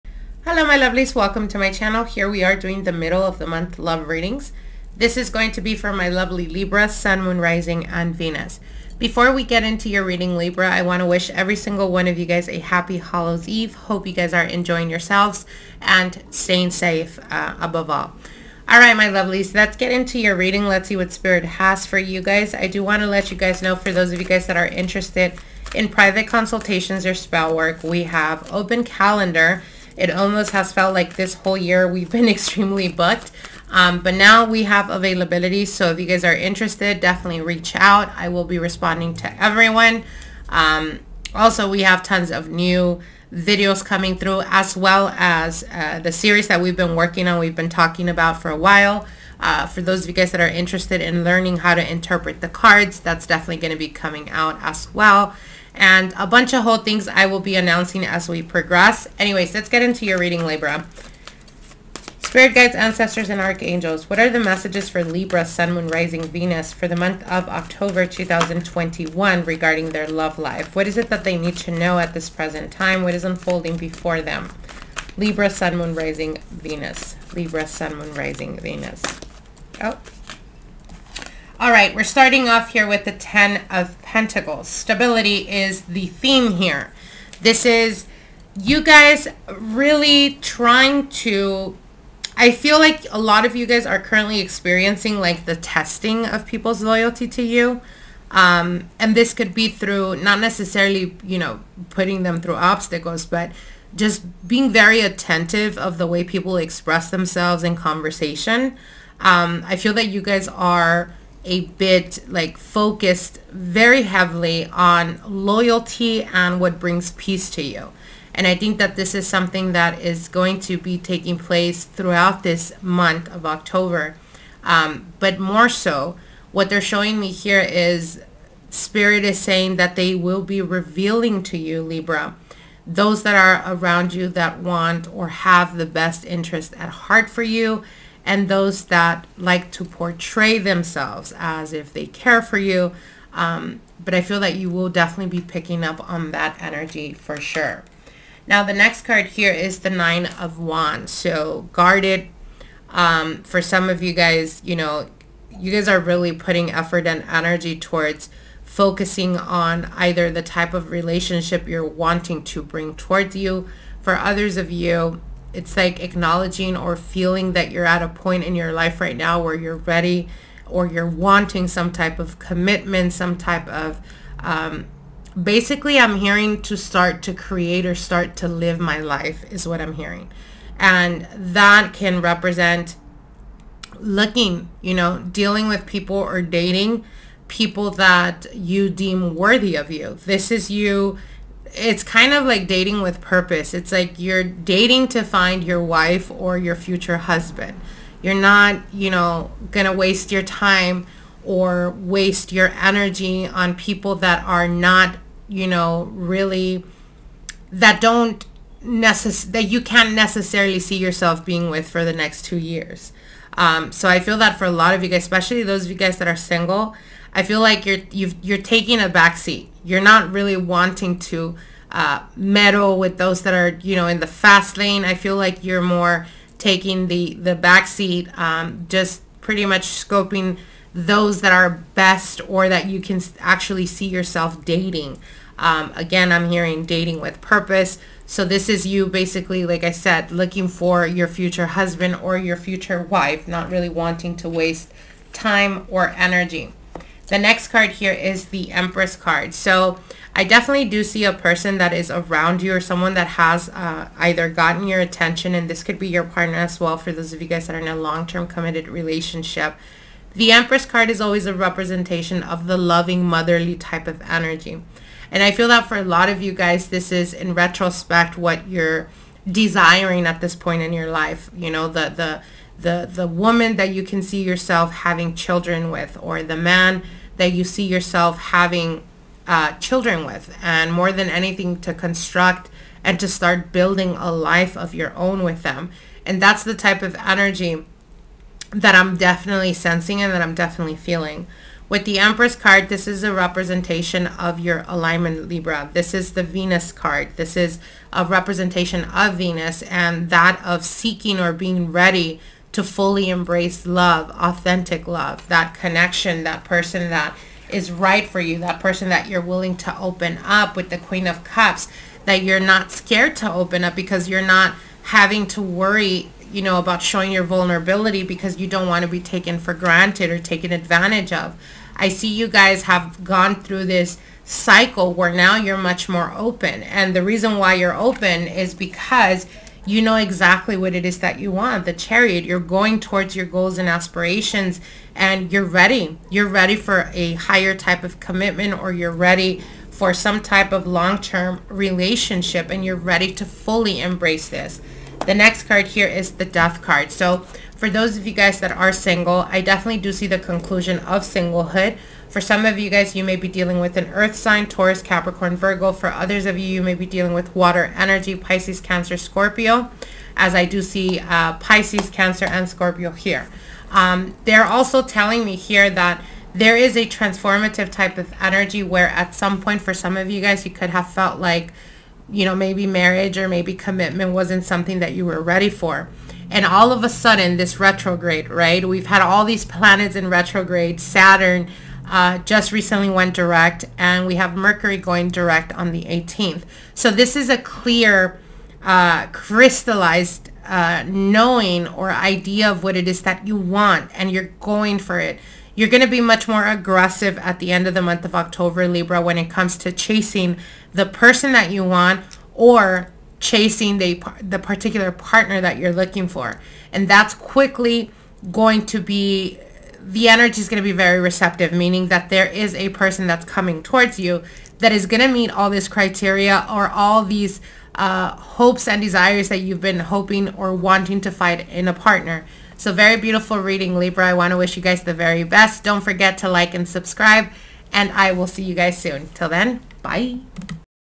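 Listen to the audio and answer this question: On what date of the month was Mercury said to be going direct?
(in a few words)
18th.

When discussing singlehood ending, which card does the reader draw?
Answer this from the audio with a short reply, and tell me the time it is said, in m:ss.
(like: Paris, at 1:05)
Death, at 5:46.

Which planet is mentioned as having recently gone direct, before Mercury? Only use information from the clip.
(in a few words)
Saturn.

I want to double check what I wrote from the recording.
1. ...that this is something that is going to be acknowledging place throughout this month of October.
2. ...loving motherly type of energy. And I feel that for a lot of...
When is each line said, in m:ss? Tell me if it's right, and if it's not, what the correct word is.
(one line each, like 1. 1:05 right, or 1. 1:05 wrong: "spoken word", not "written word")
1. 1:58 wrong: "taking", not "acknowledging"
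2. 4:22 right.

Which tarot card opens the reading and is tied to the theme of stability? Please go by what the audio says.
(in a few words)
10 of Pentacles.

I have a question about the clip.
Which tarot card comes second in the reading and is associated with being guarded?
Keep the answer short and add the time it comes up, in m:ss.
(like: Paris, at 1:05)
Nine of Wands, at 2:29.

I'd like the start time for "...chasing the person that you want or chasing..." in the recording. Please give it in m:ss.
6:39.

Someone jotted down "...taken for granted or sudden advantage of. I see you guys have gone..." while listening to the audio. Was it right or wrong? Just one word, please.
wrong.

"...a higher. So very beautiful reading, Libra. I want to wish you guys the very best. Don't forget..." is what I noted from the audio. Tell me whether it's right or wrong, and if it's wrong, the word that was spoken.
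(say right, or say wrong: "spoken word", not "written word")
wrong: "partner", not "higher".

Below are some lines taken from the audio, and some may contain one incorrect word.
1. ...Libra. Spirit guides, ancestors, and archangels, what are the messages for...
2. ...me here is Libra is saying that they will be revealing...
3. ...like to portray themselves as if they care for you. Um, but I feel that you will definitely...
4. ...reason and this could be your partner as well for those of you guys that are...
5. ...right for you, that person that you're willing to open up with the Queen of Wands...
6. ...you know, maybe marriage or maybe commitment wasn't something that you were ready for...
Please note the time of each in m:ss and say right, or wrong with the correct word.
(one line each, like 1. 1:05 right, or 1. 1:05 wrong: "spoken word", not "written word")
1. 1:00 right
2. 2:07 wrong: "Spirit", not "Libra"
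3. 2:19 right
4. 4:14 wrong: "attention", not "reason"
5. 5:07 wrong: "Cups", not "Wands"
6. 6:12 right.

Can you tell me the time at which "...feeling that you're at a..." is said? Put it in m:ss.
2:46.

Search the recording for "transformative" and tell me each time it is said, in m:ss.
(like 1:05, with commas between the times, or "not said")
6:07.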